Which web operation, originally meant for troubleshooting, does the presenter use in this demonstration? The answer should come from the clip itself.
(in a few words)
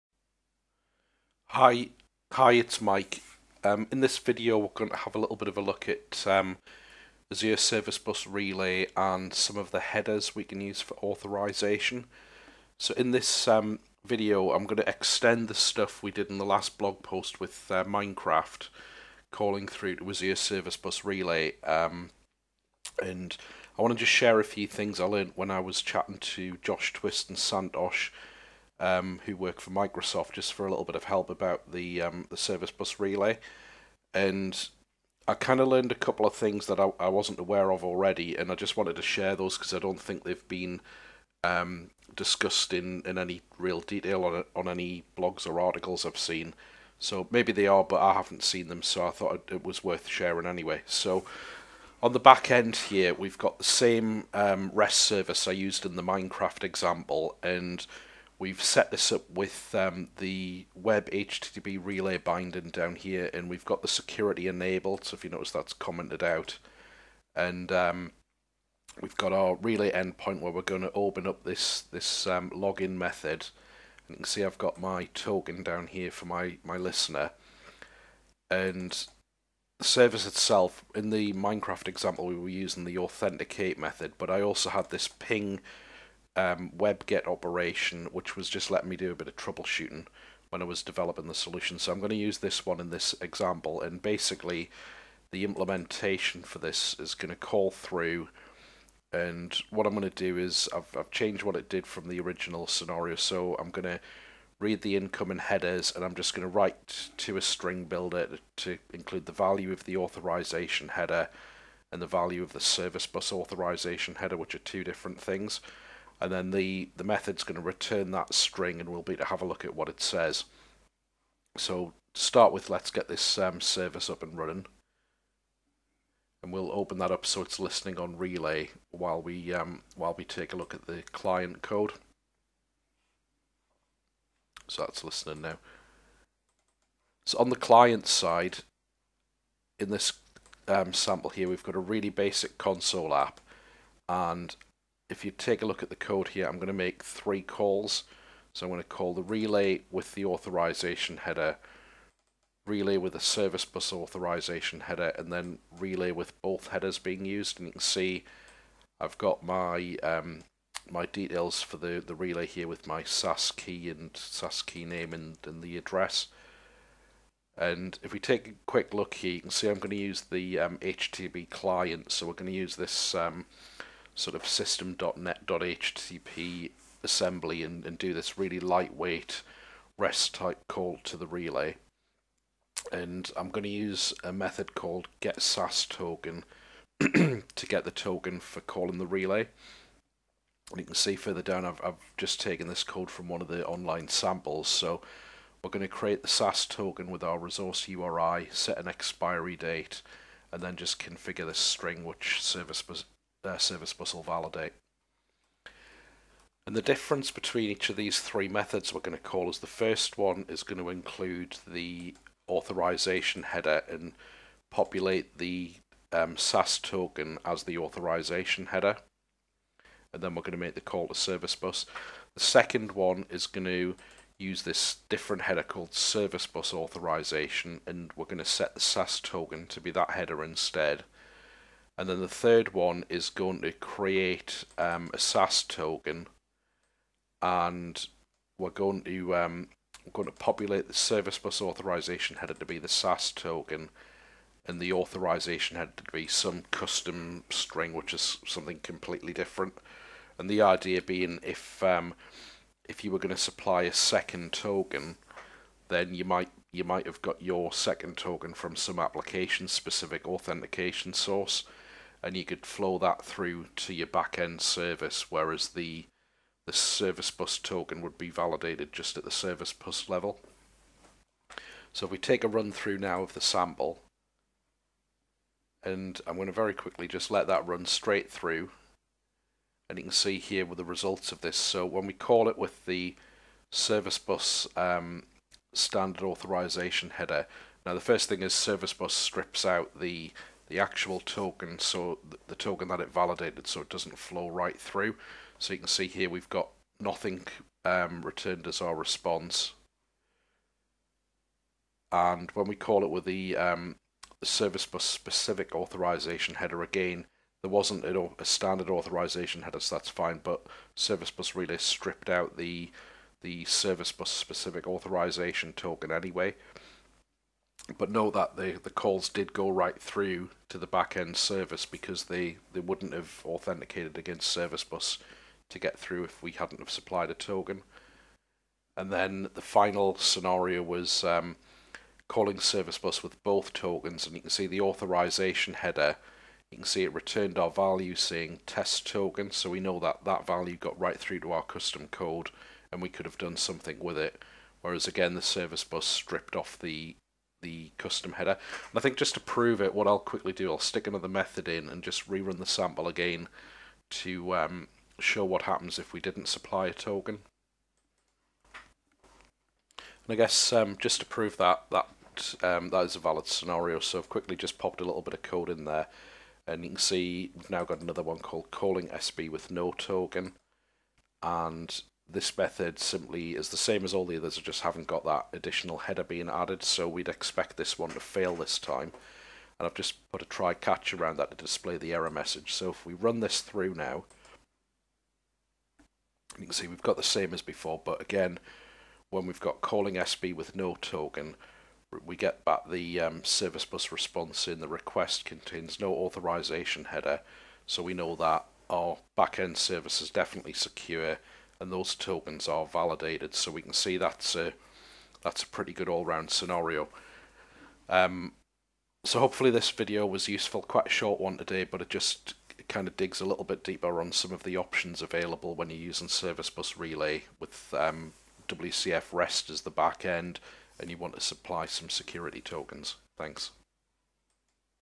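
ping.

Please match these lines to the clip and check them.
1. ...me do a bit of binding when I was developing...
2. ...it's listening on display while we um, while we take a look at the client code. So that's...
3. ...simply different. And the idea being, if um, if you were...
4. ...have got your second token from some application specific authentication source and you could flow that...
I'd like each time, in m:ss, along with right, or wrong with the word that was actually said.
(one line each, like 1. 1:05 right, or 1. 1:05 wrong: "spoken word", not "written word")
1. 1:28 wrong: "troubleshooting", not "binding"
2. 2:07 wrong: "relay", not "display"
3. 4:08 wrong: "completely", not "simply"
4. 4:17 right.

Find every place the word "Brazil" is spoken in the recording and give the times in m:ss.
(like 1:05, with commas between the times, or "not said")
not said.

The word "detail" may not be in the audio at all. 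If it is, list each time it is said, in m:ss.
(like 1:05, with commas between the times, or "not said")
0:43, 2:41.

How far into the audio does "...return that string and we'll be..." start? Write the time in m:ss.
1:57.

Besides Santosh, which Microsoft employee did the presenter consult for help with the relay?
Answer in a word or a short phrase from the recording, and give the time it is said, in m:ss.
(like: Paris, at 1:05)
Josh Twist, at 0:26.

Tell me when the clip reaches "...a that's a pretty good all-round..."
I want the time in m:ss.
6:44.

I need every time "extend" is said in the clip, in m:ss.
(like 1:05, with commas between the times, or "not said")
0:14.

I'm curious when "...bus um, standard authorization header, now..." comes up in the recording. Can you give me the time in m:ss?
4:44.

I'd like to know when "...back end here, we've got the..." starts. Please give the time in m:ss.
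0:52.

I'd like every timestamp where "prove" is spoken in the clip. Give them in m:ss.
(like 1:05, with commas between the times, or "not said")
5:49, 6:01.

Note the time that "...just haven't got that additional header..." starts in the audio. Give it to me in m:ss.
6:14.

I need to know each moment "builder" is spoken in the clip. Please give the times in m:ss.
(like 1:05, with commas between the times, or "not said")
1:47.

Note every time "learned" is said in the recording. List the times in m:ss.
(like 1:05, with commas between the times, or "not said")
0:25, 0:35.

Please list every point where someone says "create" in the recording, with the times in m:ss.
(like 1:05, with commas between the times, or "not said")
3:15, 3:53.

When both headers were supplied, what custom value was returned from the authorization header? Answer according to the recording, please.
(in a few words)
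test token.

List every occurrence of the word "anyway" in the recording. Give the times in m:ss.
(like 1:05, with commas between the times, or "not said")
0:50, 5:16.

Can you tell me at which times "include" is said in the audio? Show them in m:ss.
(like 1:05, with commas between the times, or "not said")
1:48, 3:30.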